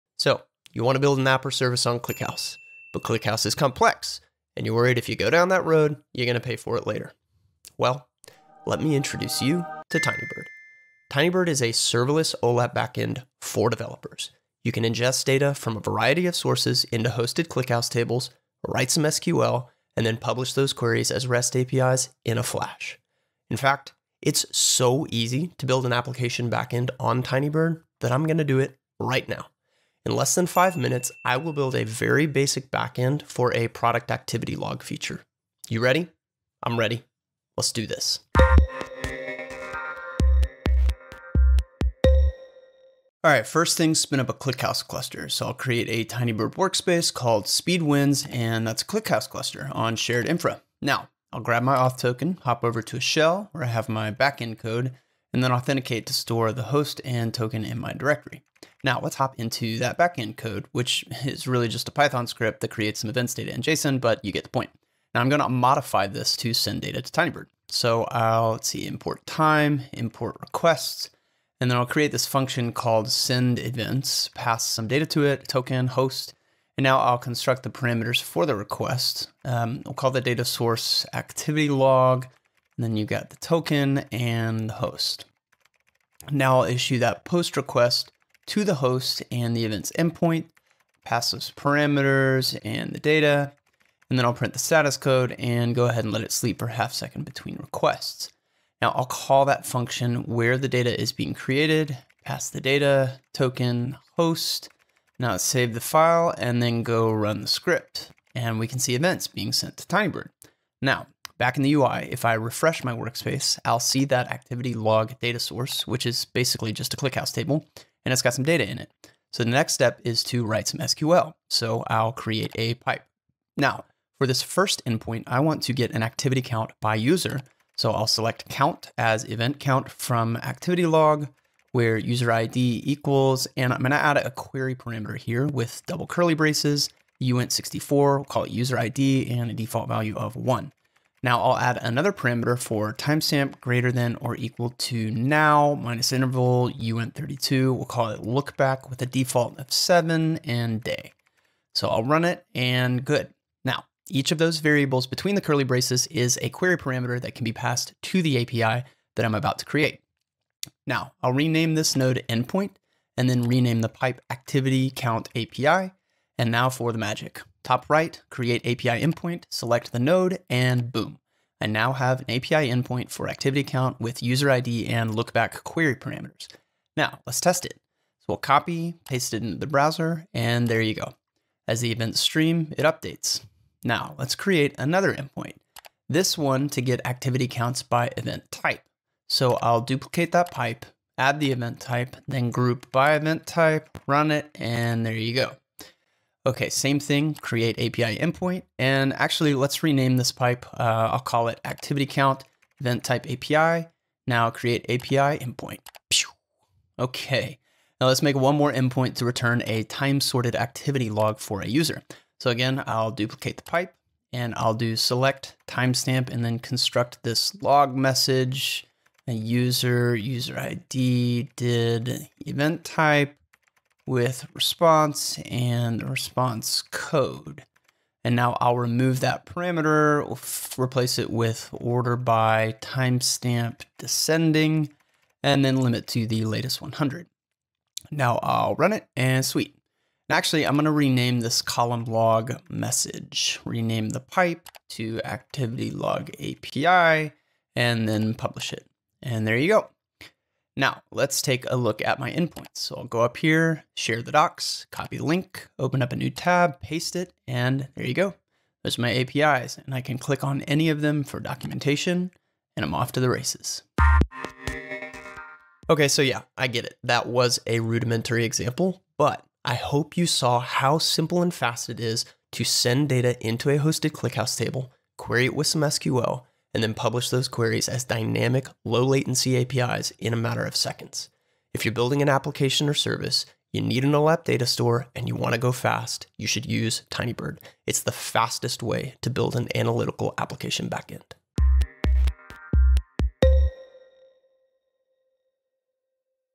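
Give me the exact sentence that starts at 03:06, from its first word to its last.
This one to get activity counts by event type.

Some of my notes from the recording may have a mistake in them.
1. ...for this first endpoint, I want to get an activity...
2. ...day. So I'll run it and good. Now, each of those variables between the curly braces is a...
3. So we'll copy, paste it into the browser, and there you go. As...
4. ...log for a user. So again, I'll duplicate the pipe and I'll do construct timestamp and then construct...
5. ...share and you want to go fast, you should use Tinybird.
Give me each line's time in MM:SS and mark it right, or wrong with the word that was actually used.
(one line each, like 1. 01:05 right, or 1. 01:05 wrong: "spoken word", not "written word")
1. 02:04 right
2. 02:30 right
3. 02:58 right
4. 03:31 wrong: "select", not "construct"
5. 04:44 wrong: "store", not "share".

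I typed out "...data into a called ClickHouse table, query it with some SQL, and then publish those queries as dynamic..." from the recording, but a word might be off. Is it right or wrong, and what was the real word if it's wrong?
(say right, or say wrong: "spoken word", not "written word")
wrong: "hosted", not "called".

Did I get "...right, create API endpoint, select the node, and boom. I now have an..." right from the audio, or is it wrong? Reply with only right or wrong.
right.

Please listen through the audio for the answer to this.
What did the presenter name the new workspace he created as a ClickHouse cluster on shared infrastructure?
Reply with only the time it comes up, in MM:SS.
00:47.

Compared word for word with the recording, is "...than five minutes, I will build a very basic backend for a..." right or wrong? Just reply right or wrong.
right.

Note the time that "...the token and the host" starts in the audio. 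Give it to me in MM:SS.
01:23.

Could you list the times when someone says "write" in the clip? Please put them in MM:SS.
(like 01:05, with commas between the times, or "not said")
00:18, 02:00.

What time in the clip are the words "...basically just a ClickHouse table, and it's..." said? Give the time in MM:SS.
01:56.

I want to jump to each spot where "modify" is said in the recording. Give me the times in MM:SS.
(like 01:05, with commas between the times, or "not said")
01:05.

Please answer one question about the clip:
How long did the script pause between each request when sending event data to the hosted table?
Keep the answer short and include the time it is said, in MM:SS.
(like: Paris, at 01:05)
half second, at 01:36.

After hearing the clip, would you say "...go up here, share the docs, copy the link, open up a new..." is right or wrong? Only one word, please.
right.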